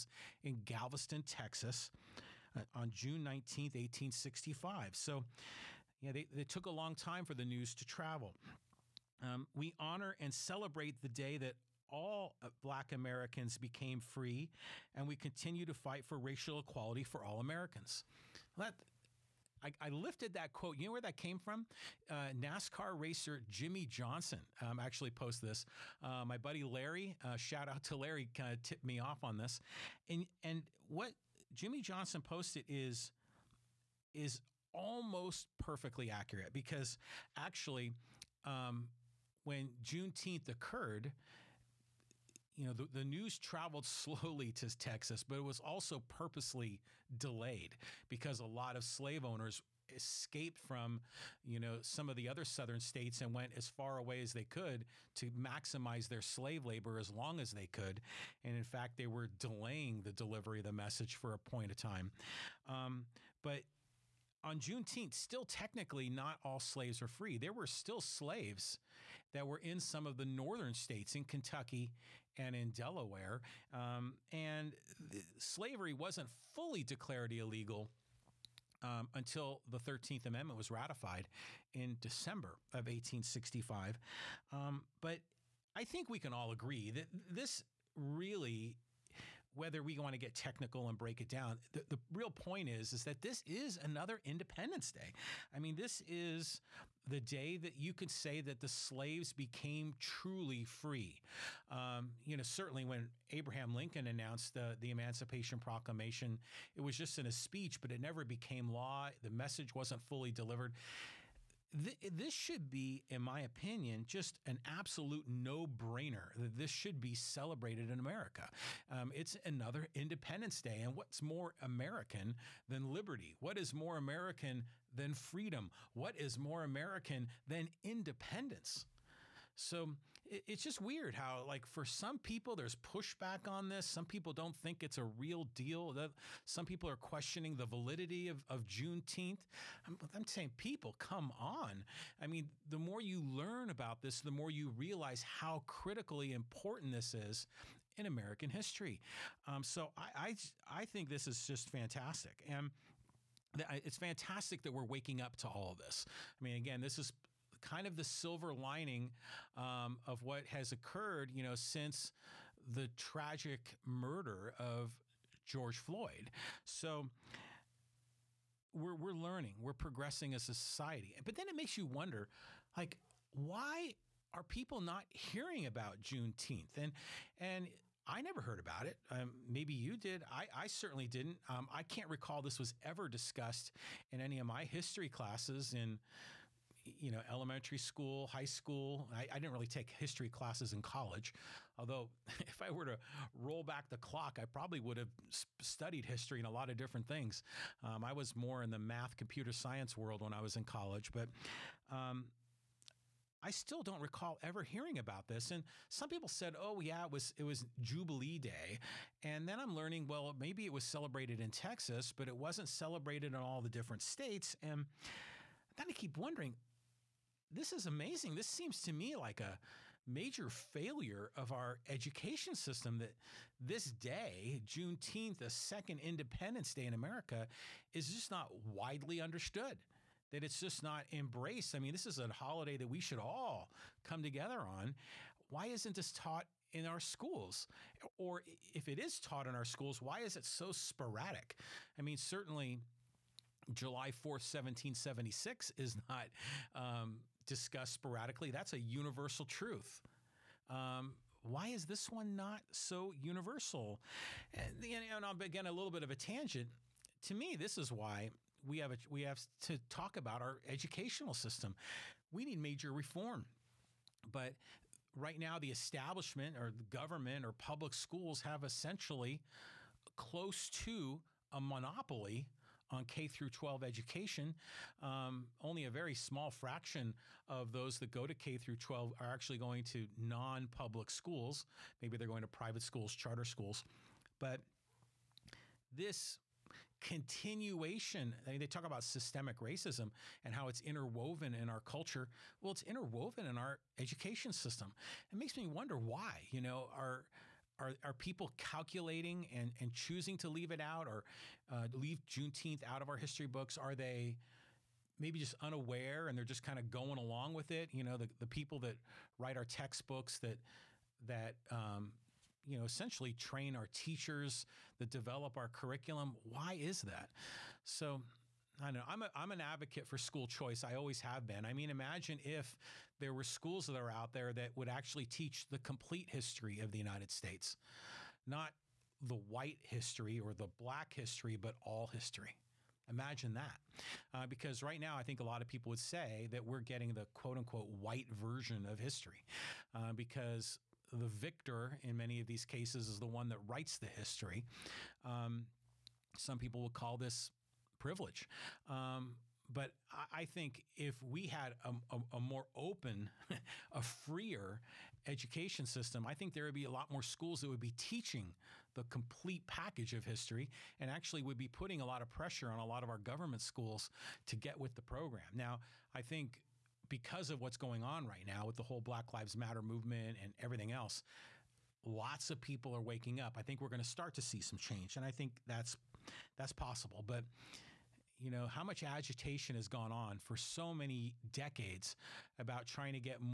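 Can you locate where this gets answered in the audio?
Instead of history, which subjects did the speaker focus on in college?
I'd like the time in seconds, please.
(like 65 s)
198 s.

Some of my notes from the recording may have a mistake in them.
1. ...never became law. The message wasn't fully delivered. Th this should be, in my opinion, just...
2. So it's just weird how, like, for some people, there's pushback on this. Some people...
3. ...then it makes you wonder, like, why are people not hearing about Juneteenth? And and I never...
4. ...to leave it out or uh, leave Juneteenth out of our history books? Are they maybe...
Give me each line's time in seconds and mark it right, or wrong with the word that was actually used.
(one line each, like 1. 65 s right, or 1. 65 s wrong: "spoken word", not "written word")
1. 107 s right
2. 129 s right
3. 171 s right
4. 300 s right.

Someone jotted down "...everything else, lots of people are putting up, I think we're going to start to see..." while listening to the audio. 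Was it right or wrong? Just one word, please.
wrong.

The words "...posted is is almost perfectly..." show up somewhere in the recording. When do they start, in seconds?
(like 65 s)
32 s.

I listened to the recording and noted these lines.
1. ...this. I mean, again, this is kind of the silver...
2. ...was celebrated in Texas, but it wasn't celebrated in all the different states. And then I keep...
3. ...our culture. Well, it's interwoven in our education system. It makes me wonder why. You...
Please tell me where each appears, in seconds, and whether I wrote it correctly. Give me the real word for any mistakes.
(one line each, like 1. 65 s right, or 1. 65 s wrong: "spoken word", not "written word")
1. 155 s right
2. 210 s right
3. 291 s right.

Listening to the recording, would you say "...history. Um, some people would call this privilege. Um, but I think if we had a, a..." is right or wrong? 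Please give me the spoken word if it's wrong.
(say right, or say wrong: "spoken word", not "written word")
right.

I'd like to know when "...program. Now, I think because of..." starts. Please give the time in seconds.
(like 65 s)
365 s.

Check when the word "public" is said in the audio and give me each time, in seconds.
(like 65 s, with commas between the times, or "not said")
267 s, 280 s.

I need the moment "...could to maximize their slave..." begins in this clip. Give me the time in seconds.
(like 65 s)
54 s.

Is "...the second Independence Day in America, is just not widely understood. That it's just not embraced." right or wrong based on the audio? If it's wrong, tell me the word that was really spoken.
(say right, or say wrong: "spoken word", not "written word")
right.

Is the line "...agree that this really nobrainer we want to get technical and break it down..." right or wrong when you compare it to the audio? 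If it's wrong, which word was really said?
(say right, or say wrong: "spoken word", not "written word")
wrong: "whether", not "nobrainer".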